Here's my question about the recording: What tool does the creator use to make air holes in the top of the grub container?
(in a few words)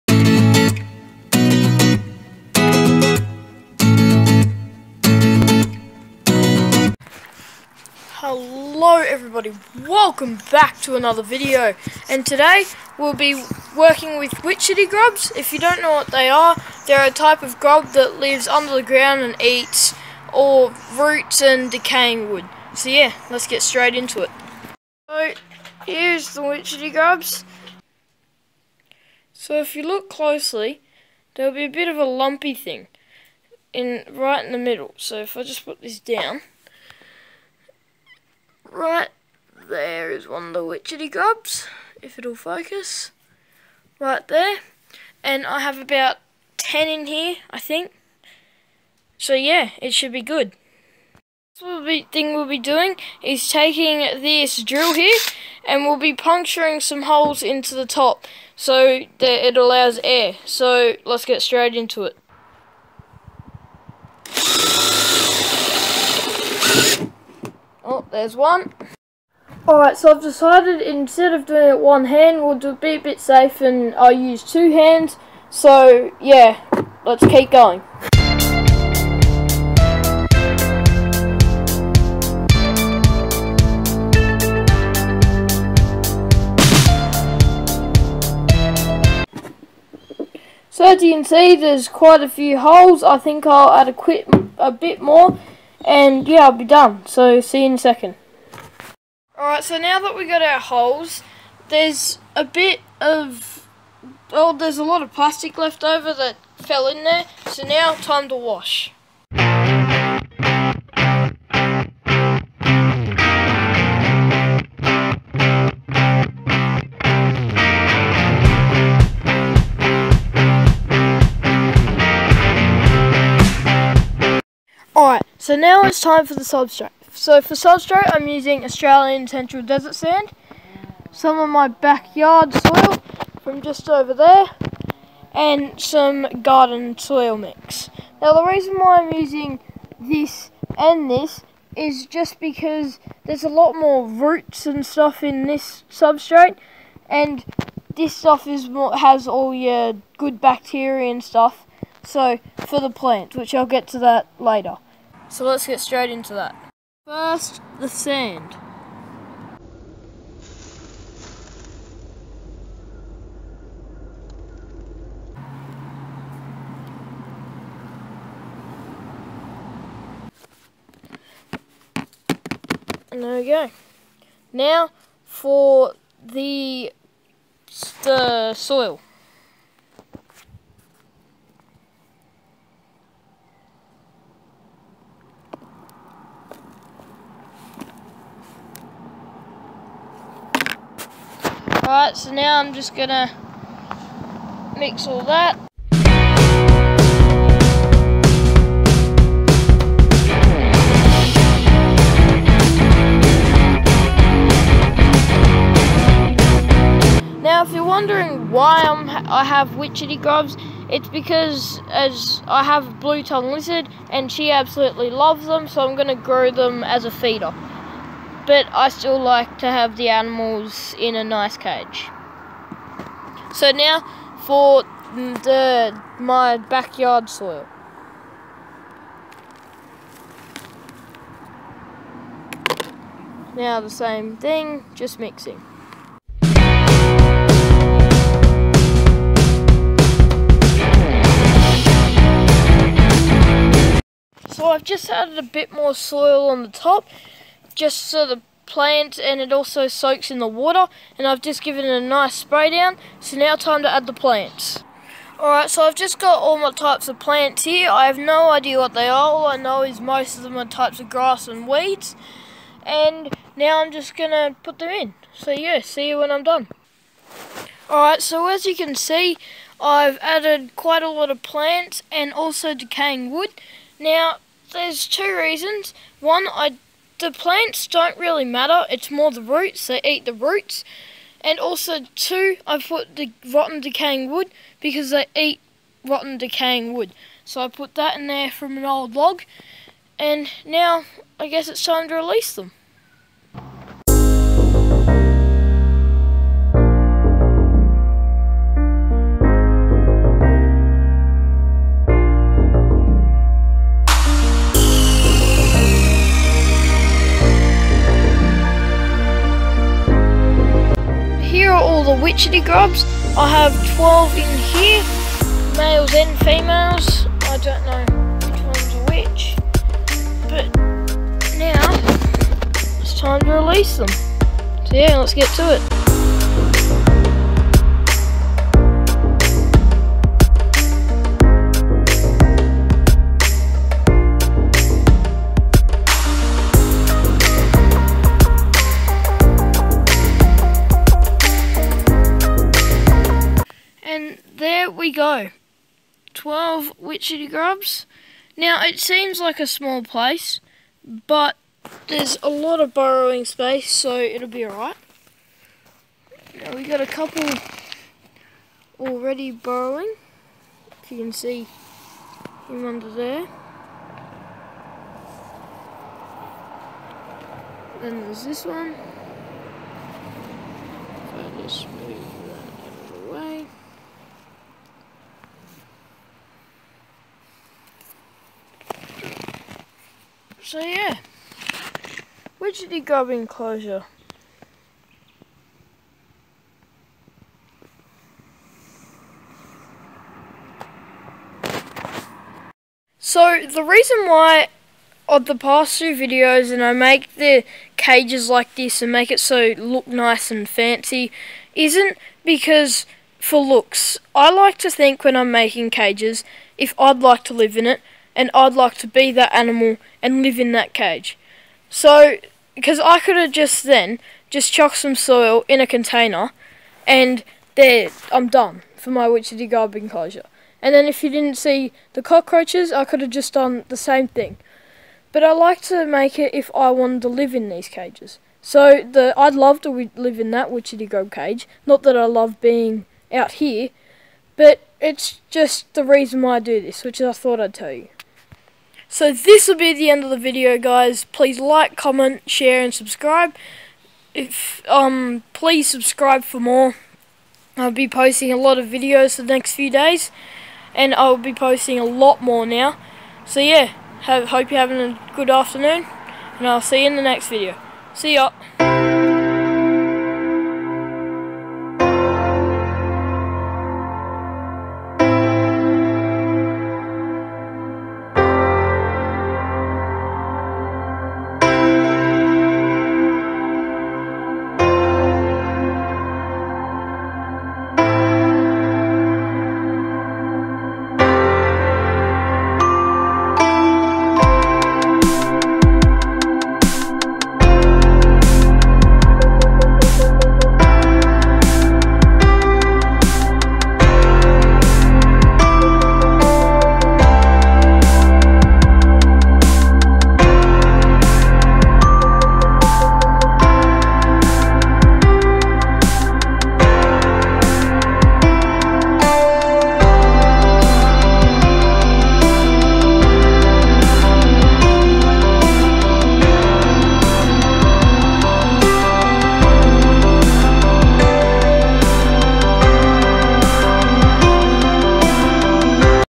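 Drill.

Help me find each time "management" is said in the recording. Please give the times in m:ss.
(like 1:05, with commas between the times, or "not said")
not said.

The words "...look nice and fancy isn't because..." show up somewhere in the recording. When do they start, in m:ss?
6:39.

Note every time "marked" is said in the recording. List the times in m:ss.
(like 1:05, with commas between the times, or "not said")
not said.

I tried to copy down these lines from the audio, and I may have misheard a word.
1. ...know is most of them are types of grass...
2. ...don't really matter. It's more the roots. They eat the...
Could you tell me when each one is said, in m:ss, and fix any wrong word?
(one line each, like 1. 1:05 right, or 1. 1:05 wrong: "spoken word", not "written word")
1. 4:19 right
2. 4:37 right.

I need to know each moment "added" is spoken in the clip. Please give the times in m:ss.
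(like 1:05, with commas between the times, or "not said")
4:05, 4:30.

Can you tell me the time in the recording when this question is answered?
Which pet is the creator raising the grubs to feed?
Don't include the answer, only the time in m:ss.
3:33.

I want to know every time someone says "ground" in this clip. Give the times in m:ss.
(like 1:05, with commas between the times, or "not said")
0:18.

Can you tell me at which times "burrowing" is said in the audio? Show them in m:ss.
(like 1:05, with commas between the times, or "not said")
5:52, 5:59.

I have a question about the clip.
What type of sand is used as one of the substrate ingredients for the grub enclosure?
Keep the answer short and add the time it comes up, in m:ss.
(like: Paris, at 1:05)
Australian Central Desert sand, at 2:08.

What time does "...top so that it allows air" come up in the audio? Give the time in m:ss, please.
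0:57.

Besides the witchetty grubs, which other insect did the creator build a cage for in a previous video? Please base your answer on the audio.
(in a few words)
Cockroaches.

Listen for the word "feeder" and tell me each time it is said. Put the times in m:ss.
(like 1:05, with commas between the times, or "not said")
3:37.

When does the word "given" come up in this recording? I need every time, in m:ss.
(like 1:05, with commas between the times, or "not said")
4:11.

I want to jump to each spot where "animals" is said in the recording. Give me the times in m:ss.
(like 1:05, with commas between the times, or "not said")
3:40, 6:49.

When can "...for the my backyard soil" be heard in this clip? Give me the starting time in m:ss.
3:44.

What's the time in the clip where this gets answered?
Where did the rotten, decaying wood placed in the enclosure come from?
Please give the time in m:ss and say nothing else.
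4:48.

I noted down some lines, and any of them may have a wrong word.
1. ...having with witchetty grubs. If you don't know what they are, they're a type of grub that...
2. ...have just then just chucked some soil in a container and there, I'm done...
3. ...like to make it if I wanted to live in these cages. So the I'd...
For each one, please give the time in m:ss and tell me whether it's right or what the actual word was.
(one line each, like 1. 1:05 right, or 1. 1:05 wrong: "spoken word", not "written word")
1. 0:13 wrong: "working", not "having"
2. 6:53 right
3. 7:05 right.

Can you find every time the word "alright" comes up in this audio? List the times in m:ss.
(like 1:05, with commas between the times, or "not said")
1:09, 1:39, 4:15, 4:27, 5:54.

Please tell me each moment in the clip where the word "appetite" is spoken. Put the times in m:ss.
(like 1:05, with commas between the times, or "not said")
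not said.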